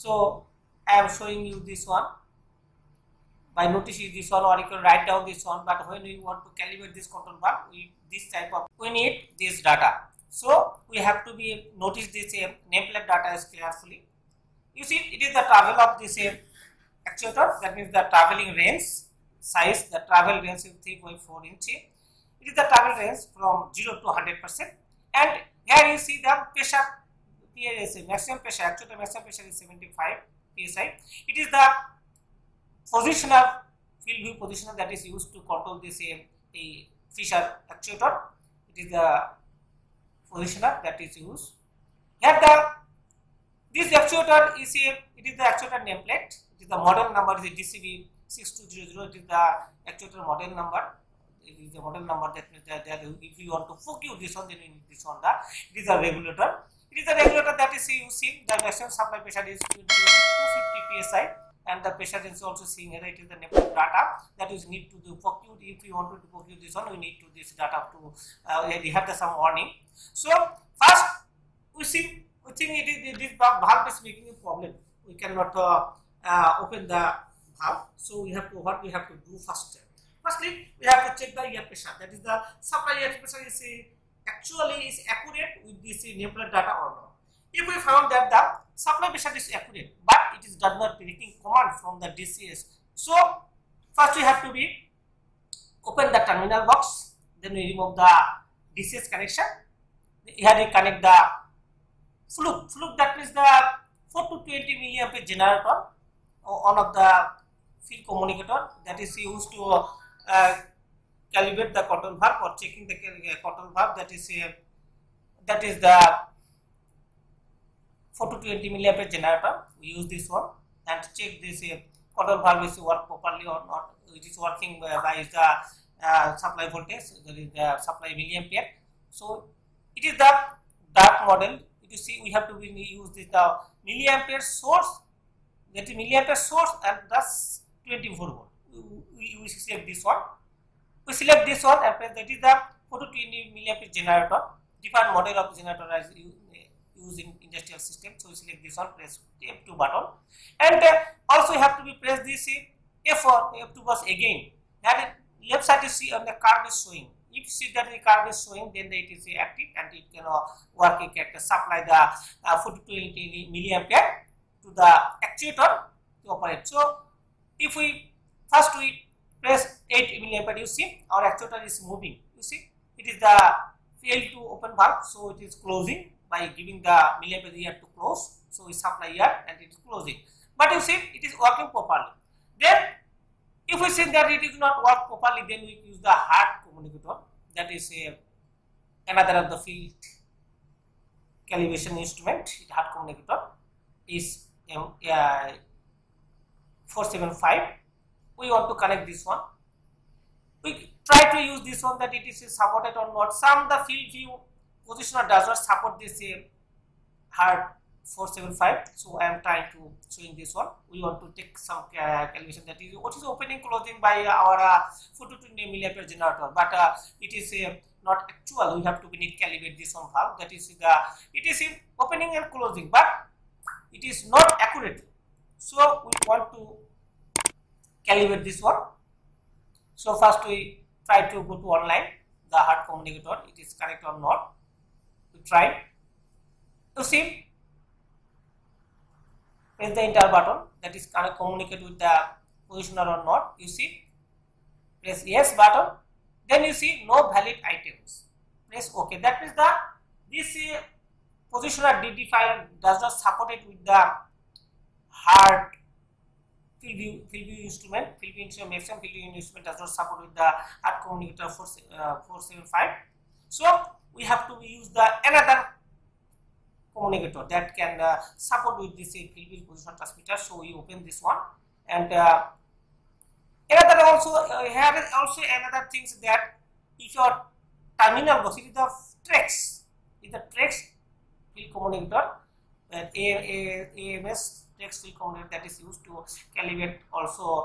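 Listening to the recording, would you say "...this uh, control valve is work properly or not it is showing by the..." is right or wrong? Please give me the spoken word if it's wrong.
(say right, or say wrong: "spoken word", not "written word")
wrong: "working", not "showing".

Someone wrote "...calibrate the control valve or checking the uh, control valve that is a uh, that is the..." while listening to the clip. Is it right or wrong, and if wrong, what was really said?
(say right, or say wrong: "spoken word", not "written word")
right.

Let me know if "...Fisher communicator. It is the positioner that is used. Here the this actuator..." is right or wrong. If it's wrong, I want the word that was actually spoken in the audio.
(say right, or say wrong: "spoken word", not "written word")
wrong: "actuator", not "communicator".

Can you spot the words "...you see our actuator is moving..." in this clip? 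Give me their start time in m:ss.
2:50.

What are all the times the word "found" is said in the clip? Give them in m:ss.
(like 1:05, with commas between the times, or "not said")
1:27.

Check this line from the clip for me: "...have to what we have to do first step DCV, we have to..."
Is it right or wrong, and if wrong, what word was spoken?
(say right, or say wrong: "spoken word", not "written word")
wrong: "Firstly", not "DCV".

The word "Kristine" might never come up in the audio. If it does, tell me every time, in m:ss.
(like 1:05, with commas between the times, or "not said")
not said.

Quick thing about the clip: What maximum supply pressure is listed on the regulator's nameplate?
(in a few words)
250 psi.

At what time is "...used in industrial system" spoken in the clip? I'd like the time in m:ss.
2:26.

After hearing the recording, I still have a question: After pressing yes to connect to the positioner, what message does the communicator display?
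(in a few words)
No valid items.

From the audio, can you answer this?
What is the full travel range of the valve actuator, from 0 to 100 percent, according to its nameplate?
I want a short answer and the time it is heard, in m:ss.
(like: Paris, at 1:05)
3.4 inch, at 0:20.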